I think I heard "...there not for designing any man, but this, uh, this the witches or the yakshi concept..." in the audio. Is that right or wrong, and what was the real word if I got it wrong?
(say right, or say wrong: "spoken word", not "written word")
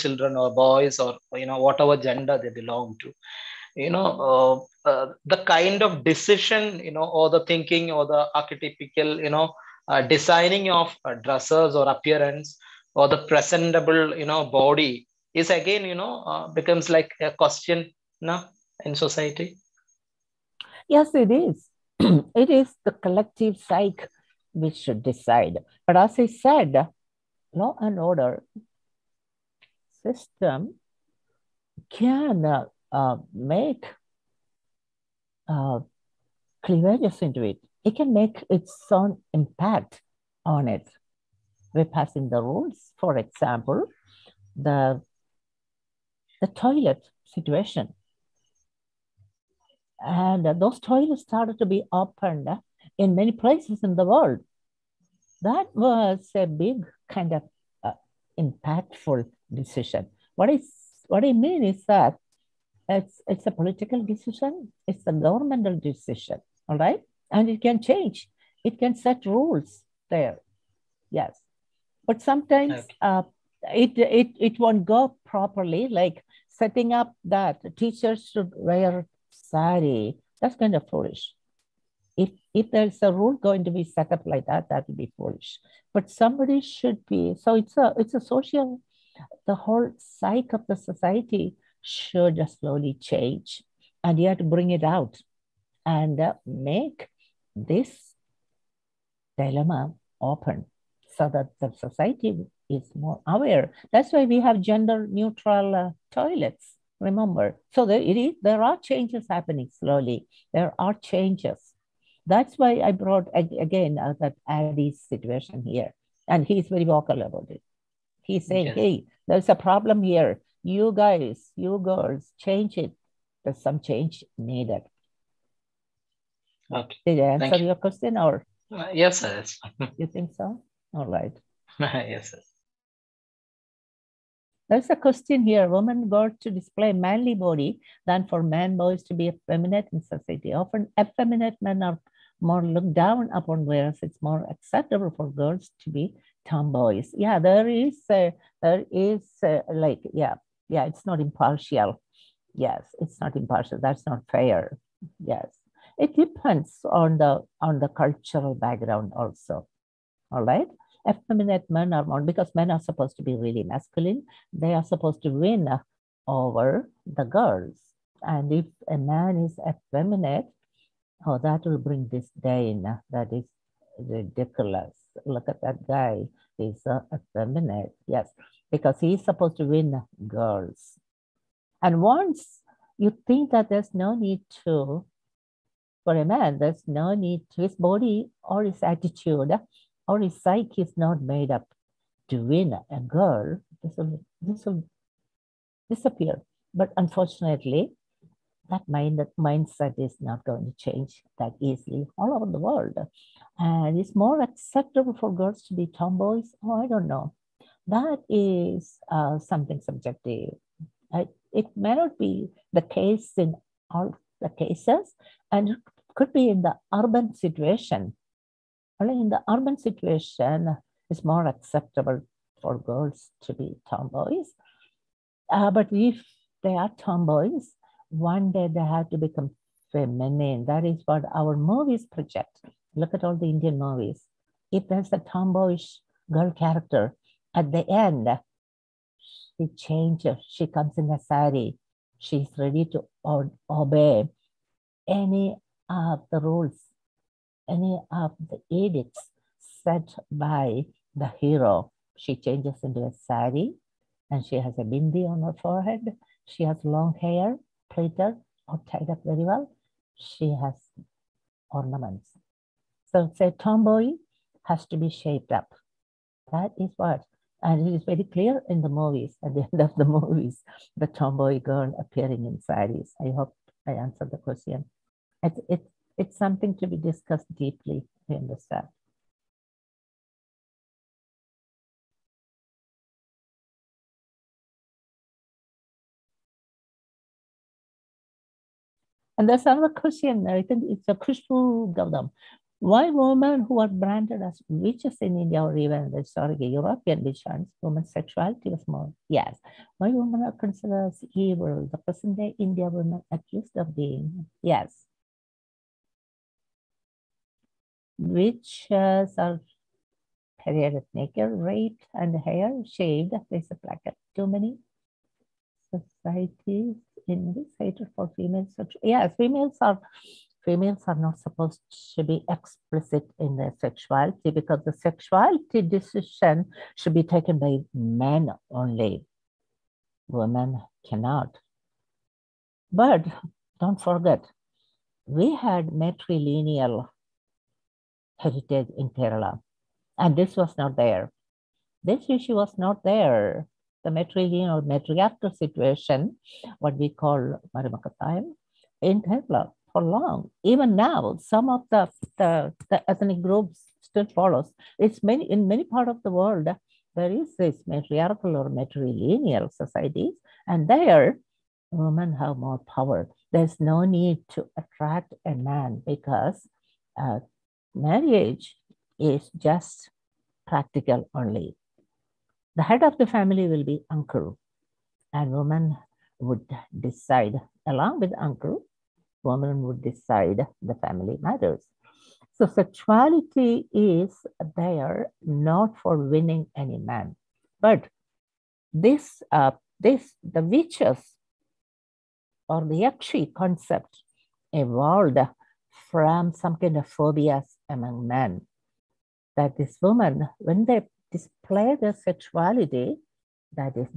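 wrong: "winning", not "designing".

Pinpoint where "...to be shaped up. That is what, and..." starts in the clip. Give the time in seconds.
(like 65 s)
264 s.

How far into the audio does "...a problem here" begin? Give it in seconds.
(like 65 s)
119 s.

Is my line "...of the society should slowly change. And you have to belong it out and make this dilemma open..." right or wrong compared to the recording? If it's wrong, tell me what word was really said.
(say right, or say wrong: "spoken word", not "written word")
wrong: "bring", not "belong".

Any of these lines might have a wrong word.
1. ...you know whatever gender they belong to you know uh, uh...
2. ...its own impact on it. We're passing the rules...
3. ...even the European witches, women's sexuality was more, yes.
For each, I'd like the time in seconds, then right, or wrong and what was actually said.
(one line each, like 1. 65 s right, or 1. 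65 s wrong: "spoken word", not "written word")
1. 1 s right
2. 38 s right
3. 295 s right.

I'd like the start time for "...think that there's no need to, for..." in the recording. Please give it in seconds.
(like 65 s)
183 s.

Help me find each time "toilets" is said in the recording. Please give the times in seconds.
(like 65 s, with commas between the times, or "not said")
46 s, 50 s, 106 s.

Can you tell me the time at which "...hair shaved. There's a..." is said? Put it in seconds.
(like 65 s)
312 s.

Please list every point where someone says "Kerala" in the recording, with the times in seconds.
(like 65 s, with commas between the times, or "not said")
339 s, 349 s.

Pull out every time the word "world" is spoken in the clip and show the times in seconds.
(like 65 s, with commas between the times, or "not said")
54 s, 202 s, 356 s.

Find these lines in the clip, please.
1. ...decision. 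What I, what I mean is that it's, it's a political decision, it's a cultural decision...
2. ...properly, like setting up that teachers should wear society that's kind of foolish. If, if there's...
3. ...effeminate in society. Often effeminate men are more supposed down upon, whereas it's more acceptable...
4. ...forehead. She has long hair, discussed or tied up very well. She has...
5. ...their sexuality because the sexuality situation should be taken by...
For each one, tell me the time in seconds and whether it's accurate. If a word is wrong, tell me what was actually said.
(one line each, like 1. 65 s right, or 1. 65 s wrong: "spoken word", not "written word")
1. 59 s wrong: "governmental", not "cultural"
2. 75 s right
3. 139 s wrong: "looked", not "supposed"
4. 255 s wrong: "plaited", not "discussed"
5. 323 s wrong: "decision", not "situation".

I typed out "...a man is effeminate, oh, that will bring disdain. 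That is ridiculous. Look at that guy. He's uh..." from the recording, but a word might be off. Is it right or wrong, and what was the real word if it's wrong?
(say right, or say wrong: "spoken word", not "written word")
right.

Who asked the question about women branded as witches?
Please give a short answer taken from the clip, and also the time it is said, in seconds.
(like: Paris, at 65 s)
Khushbu Gaudam, at 291 s.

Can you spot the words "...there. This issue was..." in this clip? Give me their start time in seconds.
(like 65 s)
340 s.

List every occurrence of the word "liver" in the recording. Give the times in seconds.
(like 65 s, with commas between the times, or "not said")
not said.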